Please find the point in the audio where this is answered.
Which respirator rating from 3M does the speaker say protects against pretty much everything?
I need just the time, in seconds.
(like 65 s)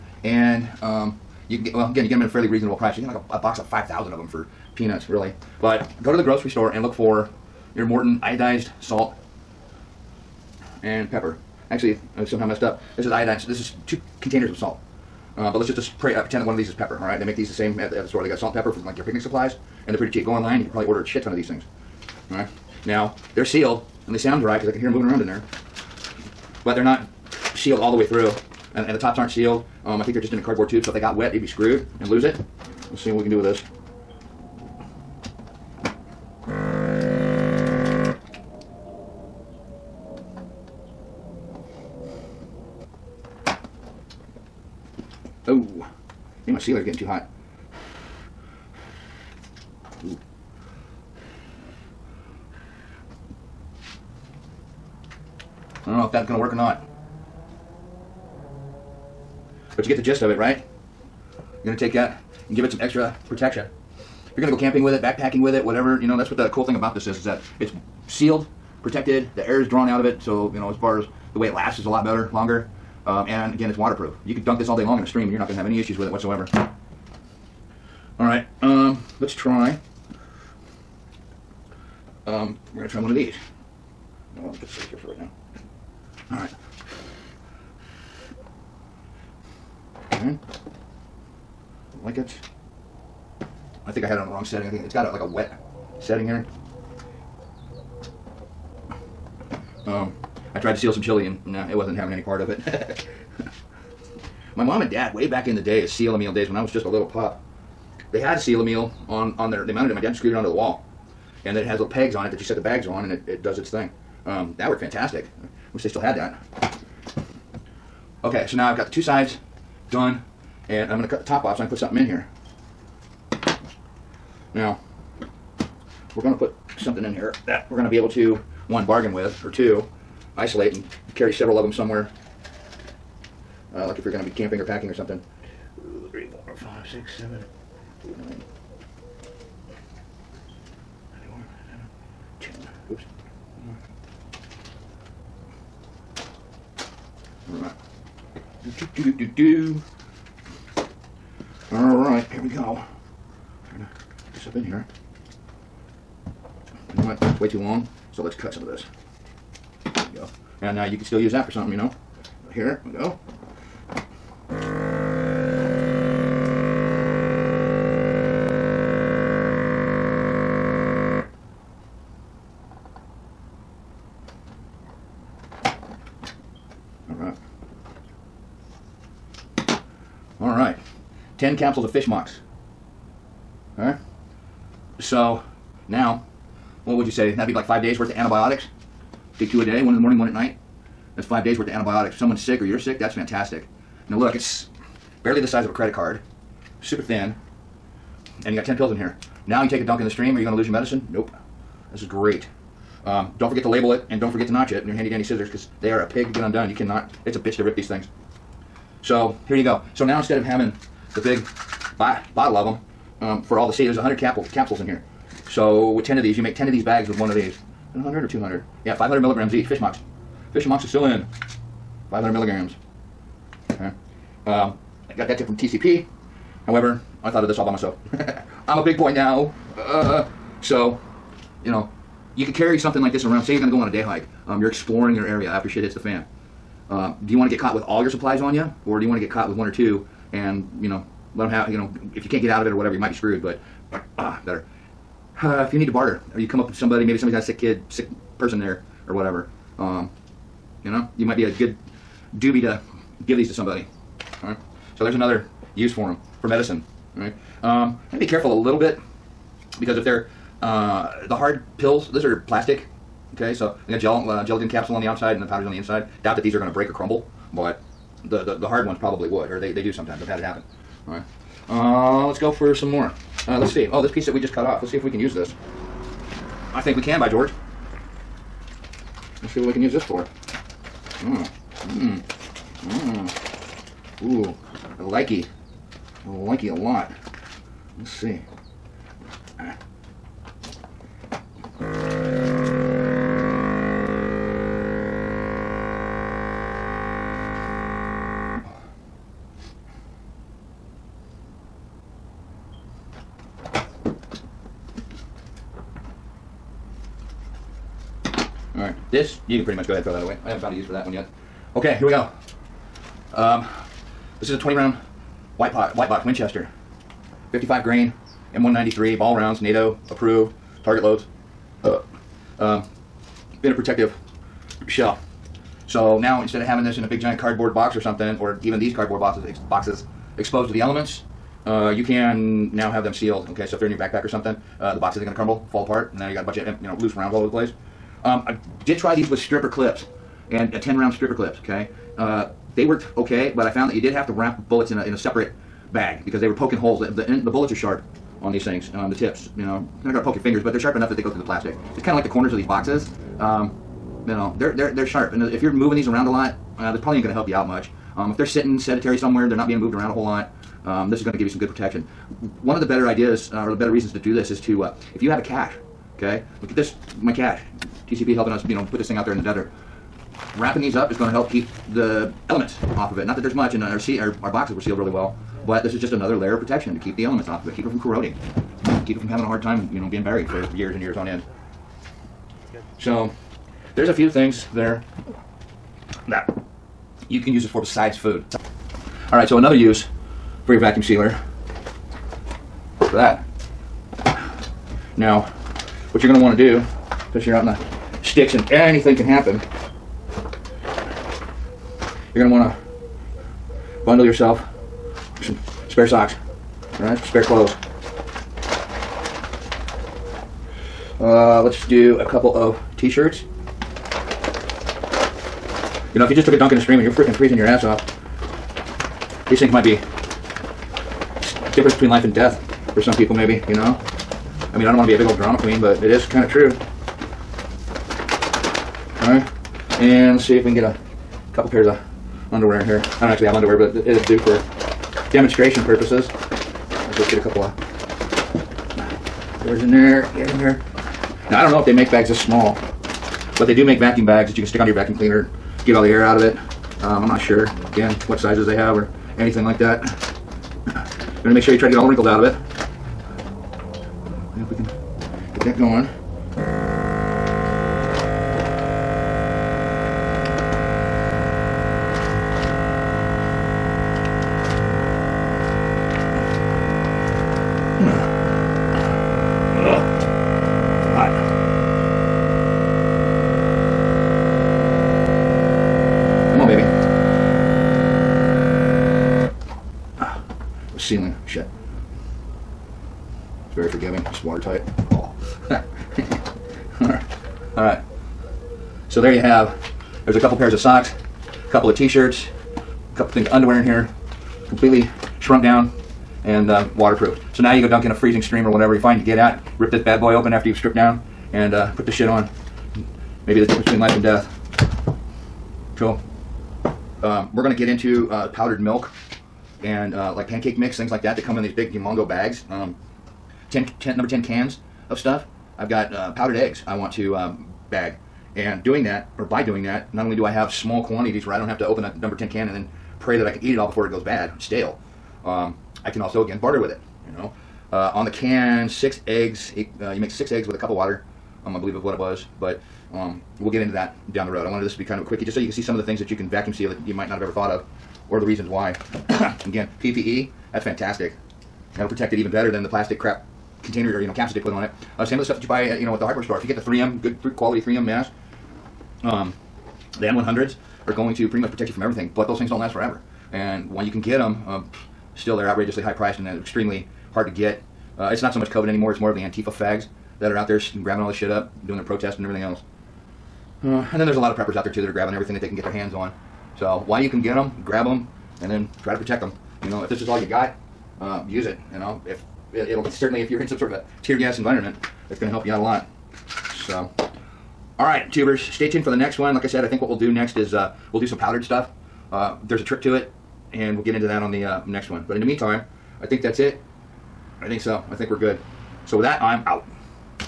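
550 s.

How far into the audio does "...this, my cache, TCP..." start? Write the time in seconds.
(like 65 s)
366 s.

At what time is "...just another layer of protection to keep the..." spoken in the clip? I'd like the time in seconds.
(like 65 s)
376 s.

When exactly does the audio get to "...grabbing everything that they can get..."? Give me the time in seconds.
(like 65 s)
565 s.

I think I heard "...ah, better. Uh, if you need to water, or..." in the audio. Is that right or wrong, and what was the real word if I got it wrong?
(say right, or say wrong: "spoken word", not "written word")
wrong: "barter", not "water".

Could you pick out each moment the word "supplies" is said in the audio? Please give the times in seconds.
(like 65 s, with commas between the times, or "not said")
19 s, 238 s.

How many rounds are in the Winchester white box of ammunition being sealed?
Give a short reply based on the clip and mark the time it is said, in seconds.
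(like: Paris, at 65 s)
20, at 314 s.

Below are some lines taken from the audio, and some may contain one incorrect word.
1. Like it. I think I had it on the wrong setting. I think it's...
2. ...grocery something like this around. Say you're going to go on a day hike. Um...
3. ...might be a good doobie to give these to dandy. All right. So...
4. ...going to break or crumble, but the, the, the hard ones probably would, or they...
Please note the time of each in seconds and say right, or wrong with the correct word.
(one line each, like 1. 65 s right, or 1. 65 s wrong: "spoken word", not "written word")
1. 92 s right
2. 232 s wrong: "carry", not "grocery"
3. 251 s wrong: "somebody", not "dandy"
4. 266 s right.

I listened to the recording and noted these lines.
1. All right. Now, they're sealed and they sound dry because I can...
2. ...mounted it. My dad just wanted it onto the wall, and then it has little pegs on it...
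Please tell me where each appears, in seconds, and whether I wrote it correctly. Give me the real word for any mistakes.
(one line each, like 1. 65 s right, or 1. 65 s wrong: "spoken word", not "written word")
1. 22 s right
2. 109 s wrong: "screwed", not "wanted".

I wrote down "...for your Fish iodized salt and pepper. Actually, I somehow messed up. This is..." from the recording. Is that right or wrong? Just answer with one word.
wrong.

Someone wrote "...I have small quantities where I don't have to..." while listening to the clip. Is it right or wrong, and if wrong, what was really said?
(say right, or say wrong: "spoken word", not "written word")
right.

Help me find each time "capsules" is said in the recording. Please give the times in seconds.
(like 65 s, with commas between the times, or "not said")
181 s, 214 s, 264 s.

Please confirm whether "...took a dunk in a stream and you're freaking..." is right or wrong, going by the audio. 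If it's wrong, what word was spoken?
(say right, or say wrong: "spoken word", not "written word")
right.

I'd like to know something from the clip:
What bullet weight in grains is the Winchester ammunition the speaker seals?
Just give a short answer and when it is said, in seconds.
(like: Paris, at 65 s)
55 grain, at 317 s.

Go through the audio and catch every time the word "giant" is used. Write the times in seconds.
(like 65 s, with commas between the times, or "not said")
327 s.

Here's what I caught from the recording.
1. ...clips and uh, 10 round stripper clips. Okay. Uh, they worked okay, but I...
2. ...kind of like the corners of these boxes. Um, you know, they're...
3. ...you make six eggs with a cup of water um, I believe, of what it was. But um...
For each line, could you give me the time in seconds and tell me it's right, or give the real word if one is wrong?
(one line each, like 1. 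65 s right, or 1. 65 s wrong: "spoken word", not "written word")
1. 339 s right
2. 352 s right
3. 530 s right.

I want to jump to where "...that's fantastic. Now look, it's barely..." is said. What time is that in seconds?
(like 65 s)
192 s.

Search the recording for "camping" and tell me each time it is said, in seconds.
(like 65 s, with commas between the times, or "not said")
64 s, 134 s.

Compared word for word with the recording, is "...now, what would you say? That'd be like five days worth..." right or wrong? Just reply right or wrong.
right.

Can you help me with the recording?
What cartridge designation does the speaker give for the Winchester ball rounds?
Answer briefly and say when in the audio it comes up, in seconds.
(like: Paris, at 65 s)
M193, at 318 s.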